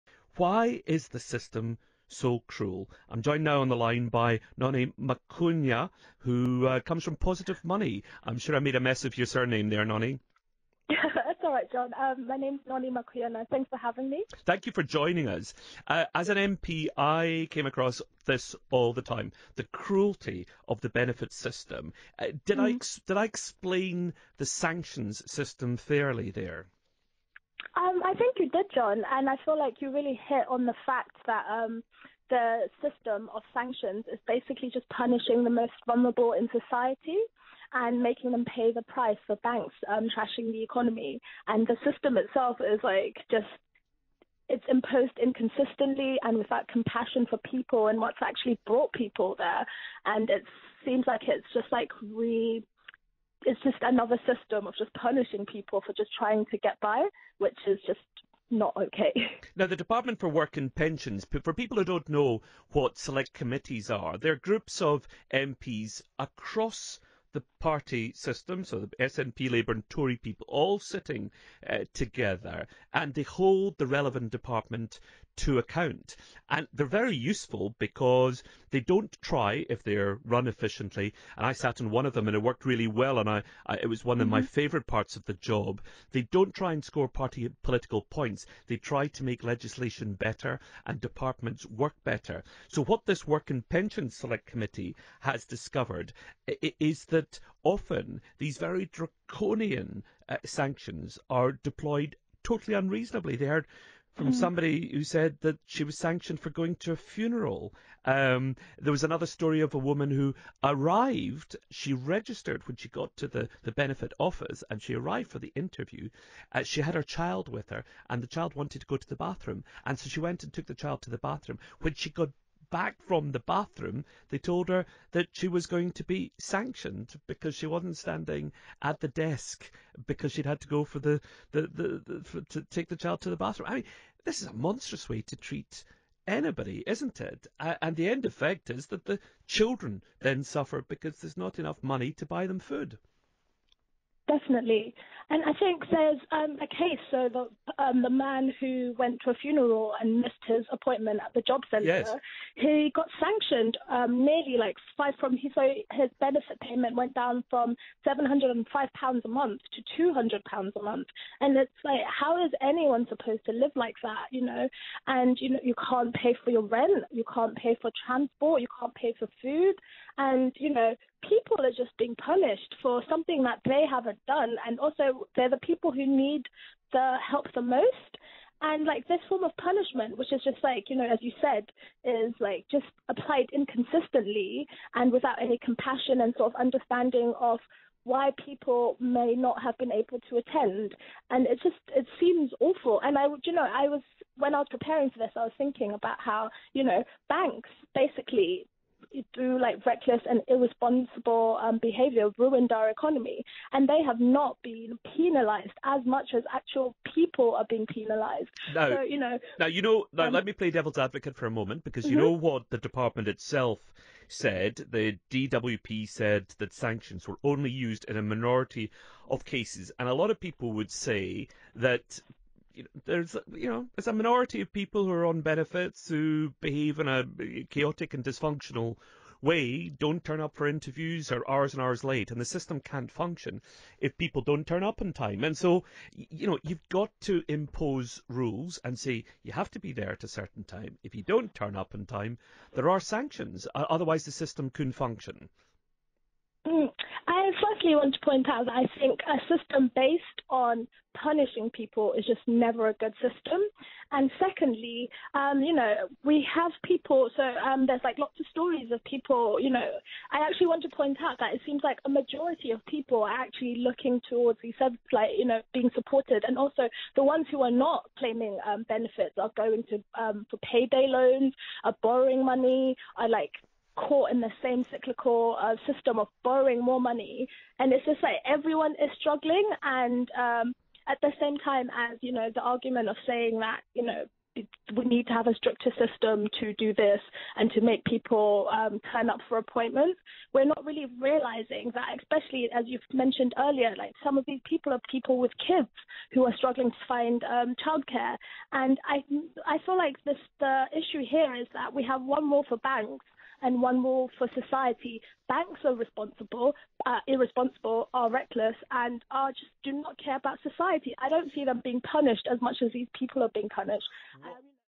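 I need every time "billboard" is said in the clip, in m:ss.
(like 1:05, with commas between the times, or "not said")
not said.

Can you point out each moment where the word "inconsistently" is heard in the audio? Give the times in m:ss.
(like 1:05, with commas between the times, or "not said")
0:45, 3:03.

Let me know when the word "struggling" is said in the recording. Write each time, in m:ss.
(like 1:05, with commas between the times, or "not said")
4:39, 4:56.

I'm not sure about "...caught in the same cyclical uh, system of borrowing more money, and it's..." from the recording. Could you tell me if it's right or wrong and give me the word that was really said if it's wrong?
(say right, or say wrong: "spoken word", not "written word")
right.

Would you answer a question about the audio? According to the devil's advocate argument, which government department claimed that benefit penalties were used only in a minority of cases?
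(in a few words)
DWP.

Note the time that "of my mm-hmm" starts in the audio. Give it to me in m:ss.
1:24.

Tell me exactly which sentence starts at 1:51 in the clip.
She registered when she got to the, the benefit office and she arrived for the interview.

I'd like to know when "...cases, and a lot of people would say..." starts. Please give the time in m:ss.
3:39.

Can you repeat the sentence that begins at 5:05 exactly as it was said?
Banks are responsible, uh, irresponsible, are reckless, and are just do not care about society.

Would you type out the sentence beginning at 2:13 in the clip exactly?
I mean, this is a monstrous way to treat anybody, isn't it?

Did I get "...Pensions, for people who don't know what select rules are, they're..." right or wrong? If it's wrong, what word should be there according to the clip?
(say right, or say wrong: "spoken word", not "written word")
wrong: "committees", not "rules".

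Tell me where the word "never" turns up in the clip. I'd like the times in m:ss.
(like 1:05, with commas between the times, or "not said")
4:12.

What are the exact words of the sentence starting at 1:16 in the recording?
And they're very useful because they don't try if they're run efficiently.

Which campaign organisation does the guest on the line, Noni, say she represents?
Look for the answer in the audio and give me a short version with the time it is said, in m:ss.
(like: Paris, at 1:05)
Positive Money, at 0:07.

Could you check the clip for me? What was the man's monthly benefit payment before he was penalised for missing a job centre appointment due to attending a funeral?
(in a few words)
£705.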